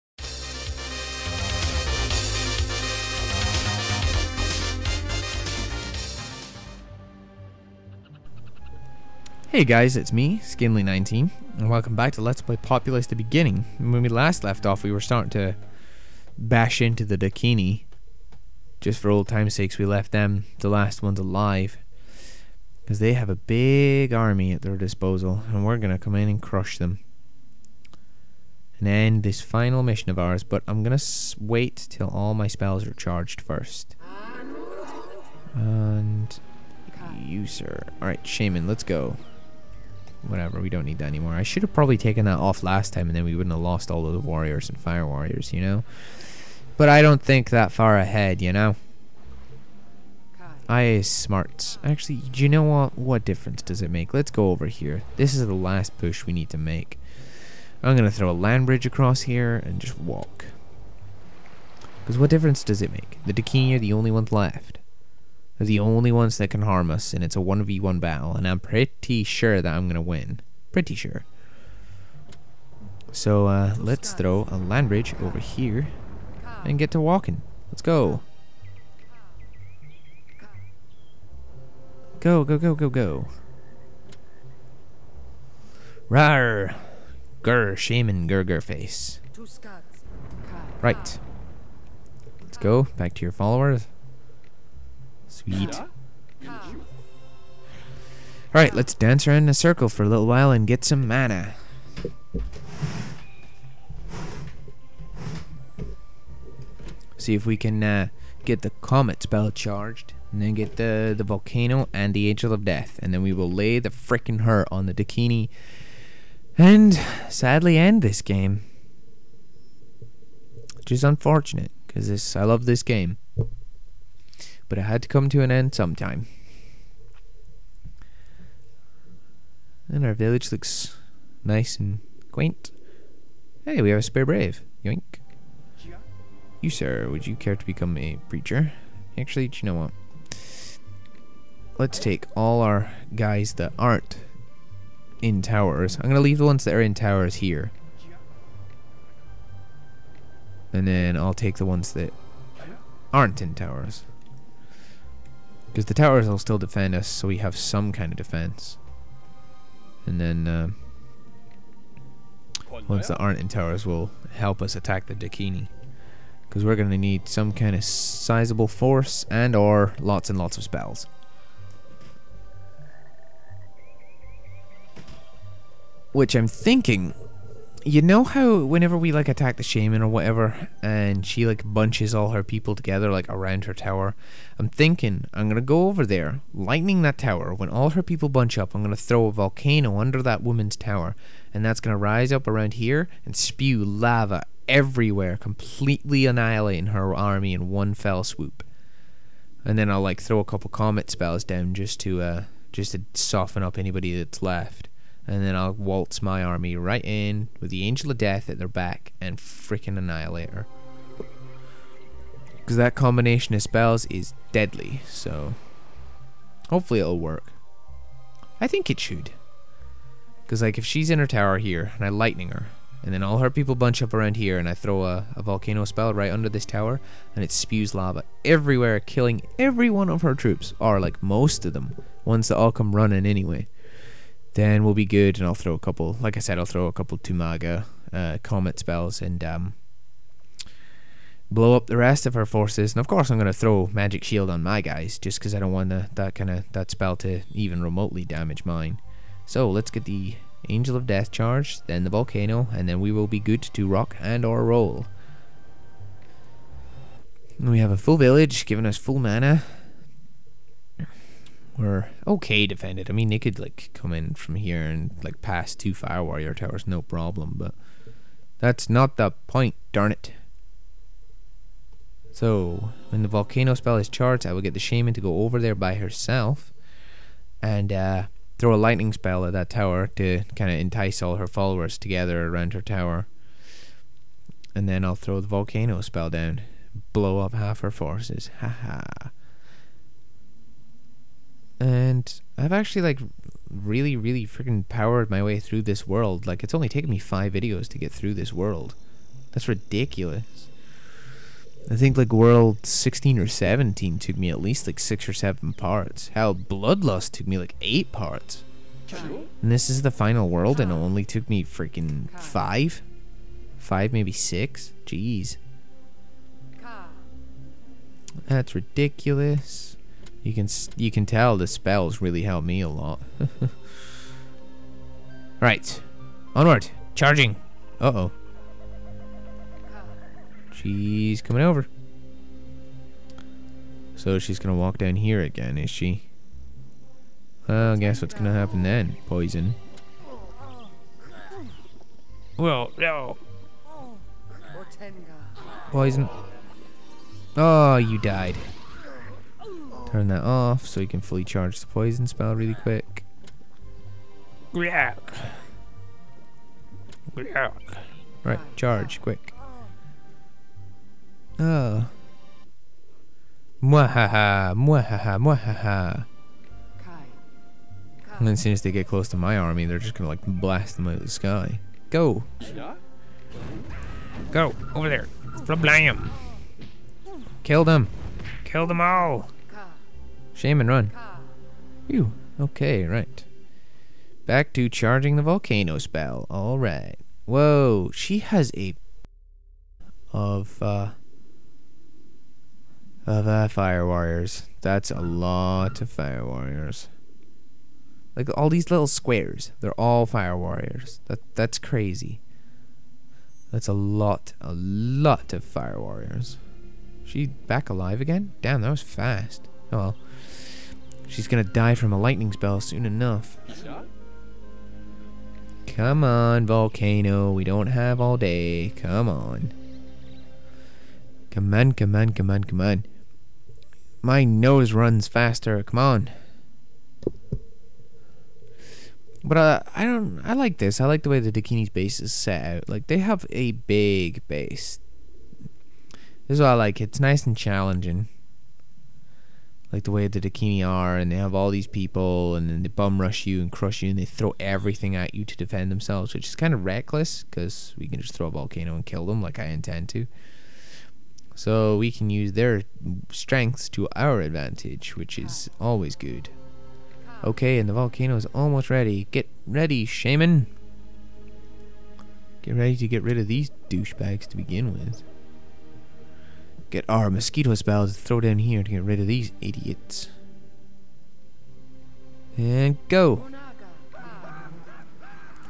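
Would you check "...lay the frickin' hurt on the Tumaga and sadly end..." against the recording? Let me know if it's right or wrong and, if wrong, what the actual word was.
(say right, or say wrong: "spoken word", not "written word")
wrong: "Dakini", not "Tumaga".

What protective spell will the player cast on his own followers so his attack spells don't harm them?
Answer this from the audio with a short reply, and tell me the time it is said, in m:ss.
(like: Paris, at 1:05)
magic shield, at 4:03.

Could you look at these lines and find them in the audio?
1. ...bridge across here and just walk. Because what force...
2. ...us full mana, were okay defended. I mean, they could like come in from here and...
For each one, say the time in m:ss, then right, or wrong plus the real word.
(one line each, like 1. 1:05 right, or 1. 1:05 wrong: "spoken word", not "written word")
1. 0:58 wrong: "difference", not "force"
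2. 4:18 right.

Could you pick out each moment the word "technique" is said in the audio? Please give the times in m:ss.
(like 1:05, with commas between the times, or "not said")
not said.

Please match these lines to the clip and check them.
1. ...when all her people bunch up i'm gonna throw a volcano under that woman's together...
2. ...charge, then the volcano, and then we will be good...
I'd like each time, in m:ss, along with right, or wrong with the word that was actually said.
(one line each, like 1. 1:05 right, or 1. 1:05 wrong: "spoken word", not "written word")
1. 3:07 wrong: "tower", not "together"
2. 4:11 right.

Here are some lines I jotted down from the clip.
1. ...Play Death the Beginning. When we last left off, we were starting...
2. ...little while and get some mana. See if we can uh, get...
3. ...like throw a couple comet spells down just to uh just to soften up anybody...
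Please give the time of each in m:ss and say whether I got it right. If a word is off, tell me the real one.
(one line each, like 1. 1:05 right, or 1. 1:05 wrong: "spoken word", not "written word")
1. 0:12 wrong: "Populous", not "Death"
2. 1:40 right
3. 3:20 right.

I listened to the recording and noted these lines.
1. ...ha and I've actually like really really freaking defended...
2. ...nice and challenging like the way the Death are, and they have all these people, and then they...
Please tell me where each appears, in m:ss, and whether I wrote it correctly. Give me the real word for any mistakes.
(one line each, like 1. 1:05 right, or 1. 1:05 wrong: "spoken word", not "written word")
1. 4:48 wrong: "powered", not "defended"
2. 7:17 wrong: "Dakini", not "Death".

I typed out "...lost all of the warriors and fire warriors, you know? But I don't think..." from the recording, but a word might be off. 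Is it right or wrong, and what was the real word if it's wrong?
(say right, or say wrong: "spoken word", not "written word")
right.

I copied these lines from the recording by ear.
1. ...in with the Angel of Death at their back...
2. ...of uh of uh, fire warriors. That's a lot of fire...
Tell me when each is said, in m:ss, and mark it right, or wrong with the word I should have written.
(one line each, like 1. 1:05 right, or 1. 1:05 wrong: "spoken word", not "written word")
1. 3:27 right
2. 6:30 right.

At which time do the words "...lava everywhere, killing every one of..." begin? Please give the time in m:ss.
3:47.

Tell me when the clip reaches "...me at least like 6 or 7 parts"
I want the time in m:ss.
5:04.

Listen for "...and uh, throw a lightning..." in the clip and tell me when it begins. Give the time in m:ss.
4:37.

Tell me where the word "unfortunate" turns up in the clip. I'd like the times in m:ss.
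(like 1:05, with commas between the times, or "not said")
2:01.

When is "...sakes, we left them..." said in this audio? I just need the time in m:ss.
0:19.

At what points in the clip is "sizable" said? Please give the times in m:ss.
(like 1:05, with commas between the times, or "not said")
2:47.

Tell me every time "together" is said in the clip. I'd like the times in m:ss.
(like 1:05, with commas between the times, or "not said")
3:02, 4:41.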